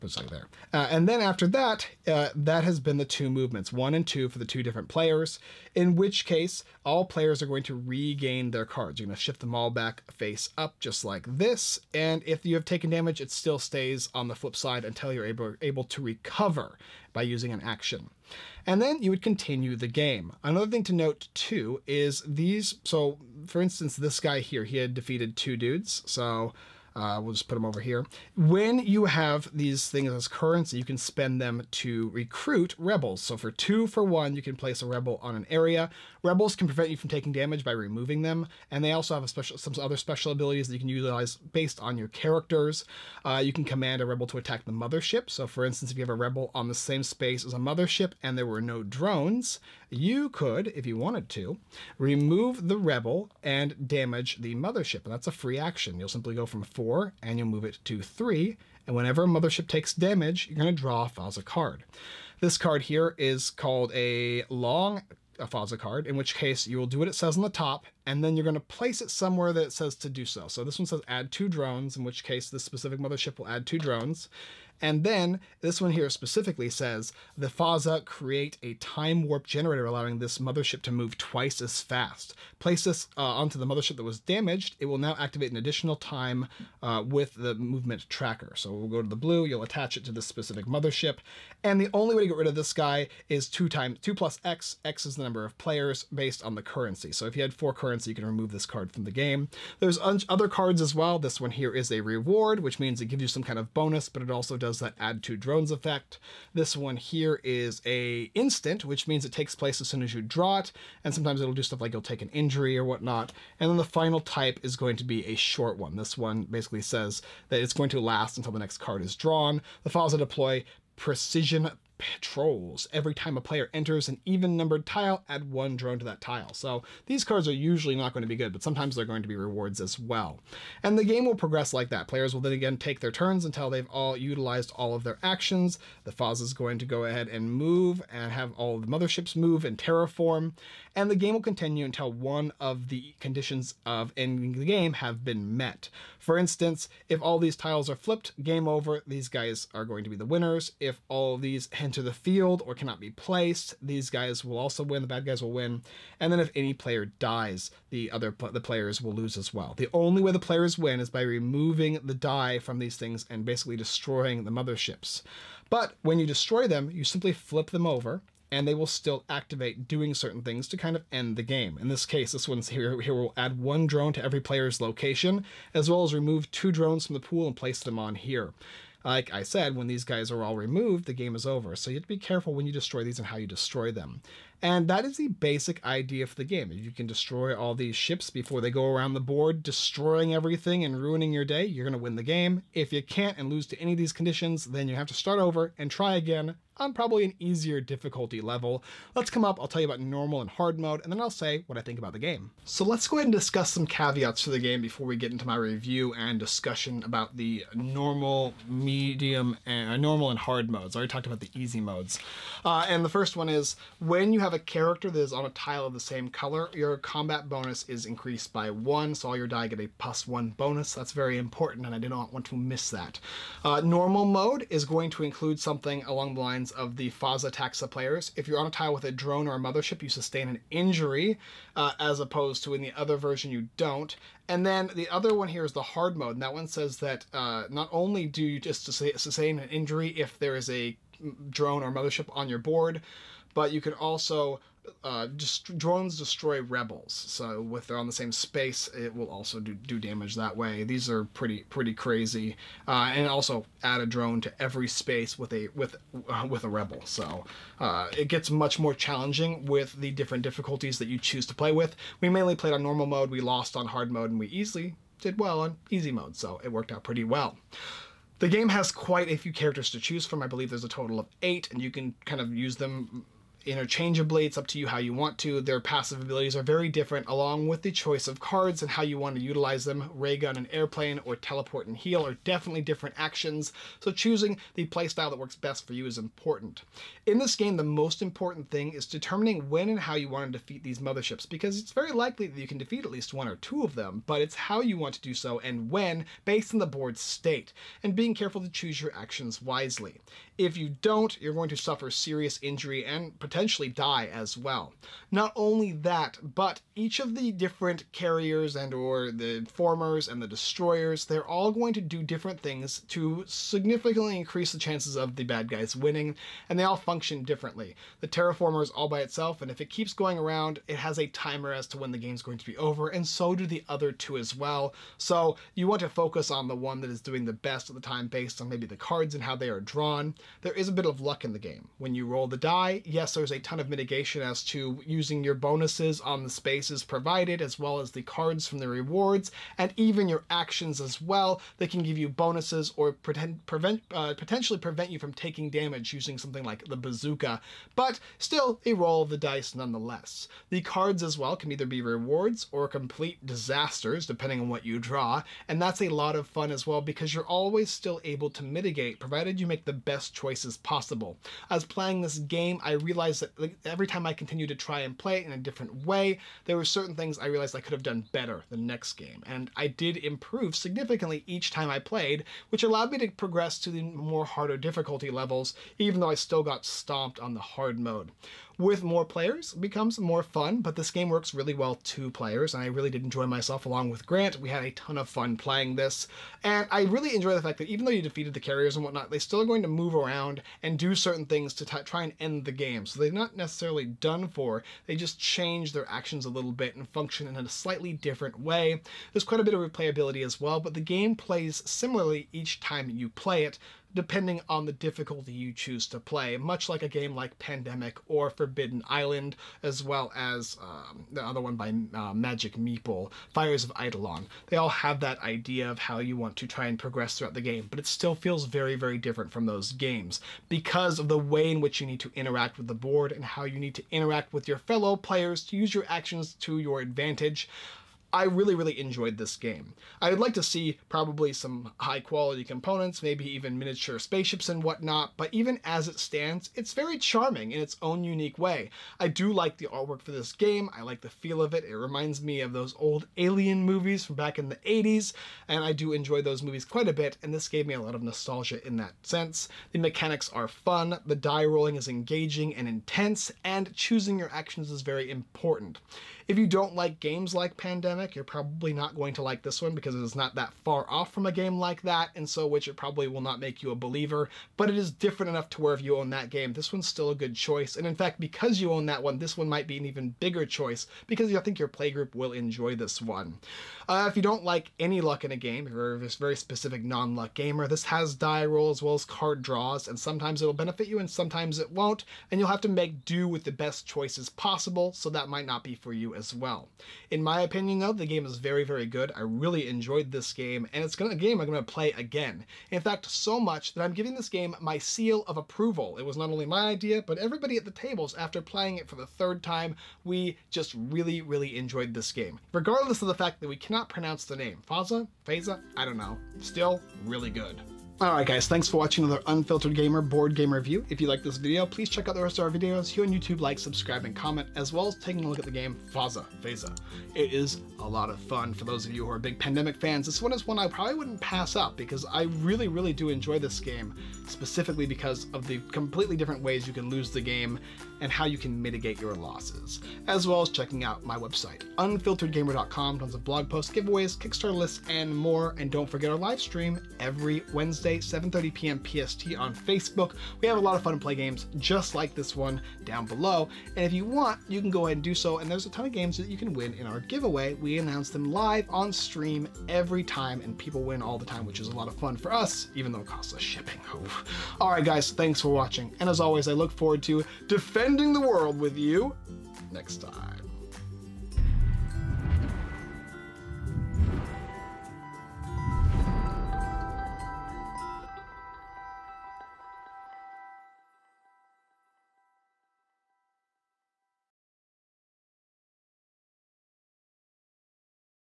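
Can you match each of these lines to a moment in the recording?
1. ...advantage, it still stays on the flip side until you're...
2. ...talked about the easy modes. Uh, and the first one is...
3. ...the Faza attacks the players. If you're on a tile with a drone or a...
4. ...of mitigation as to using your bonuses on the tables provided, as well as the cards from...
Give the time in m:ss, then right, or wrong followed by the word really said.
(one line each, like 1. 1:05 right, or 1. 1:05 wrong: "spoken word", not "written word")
1. 0:12 wrong: "damage", not "advantage"
2. 3:31 right
3. 3:46 right
4. 5:33 wrong: "spaces", not "tables".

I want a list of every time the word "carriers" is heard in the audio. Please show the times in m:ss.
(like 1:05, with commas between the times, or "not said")
5:08, 6:28.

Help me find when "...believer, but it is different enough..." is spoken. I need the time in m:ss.
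7:43.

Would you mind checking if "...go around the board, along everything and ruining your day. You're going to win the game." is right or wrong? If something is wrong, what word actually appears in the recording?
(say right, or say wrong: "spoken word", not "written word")
wrong: "destroying", not "along".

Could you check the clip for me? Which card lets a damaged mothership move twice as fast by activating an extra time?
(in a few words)
time warp generator.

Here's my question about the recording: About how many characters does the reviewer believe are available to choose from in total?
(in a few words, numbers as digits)
8.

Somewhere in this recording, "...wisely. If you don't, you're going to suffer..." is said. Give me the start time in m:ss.
4:59.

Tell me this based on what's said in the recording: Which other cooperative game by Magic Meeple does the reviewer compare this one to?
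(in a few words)
Fires of Eidolon.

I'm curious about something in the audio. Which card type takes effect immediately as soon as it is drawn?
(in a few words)
instant.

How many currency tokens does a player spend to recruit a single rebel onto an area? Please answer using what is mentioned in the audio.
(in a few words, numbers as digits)
2.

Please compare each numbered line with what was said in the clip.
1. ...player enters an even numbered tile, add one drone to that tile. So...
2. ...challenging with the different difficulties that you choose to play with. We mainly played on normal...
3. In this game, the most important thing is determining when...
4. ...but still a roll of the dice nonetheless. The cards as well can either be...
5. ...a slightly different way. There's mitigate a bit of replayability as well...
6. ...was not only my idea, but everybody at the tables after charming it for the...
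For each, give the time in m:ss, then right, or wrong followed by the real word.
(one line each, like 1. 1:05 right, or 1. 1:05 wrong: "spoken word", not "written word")
1. 2:03 right
2. 4:18 right
3. 4:47 right
4. 5:47 right
5. 6:37 wrong: "quite", not "mitigate"
6. 8:16 wrong: "playing", not "charming".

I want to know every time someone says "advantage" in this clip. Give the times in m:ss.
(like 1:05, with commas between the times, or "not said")
7:07.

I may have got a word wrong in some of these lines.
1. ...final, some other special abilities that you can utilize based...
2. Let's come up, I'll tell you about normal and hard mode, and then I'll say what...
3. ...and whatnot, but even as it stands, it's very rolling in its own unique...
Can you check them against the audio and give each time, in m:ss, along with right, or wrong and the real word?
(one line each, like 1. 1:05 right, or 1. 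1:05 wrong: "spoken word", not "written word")
1. 0:39 wrong: "special", not "final"
2. 3:19 right
3. 7:14 wrong: "charming", not "rolling".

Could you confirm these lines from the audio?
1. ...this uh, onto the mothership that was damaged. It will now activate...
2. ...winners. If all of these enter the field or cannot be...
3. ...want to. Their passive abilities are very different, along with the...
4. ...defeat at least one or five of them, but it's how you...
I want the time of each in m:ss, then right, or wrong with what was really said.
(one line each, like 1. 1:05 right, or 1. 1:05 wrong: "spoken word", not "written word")
1. 1:22 right
2. 2:30 right
3. 4:35 right
4. 4:52 wrong: "two", not "five".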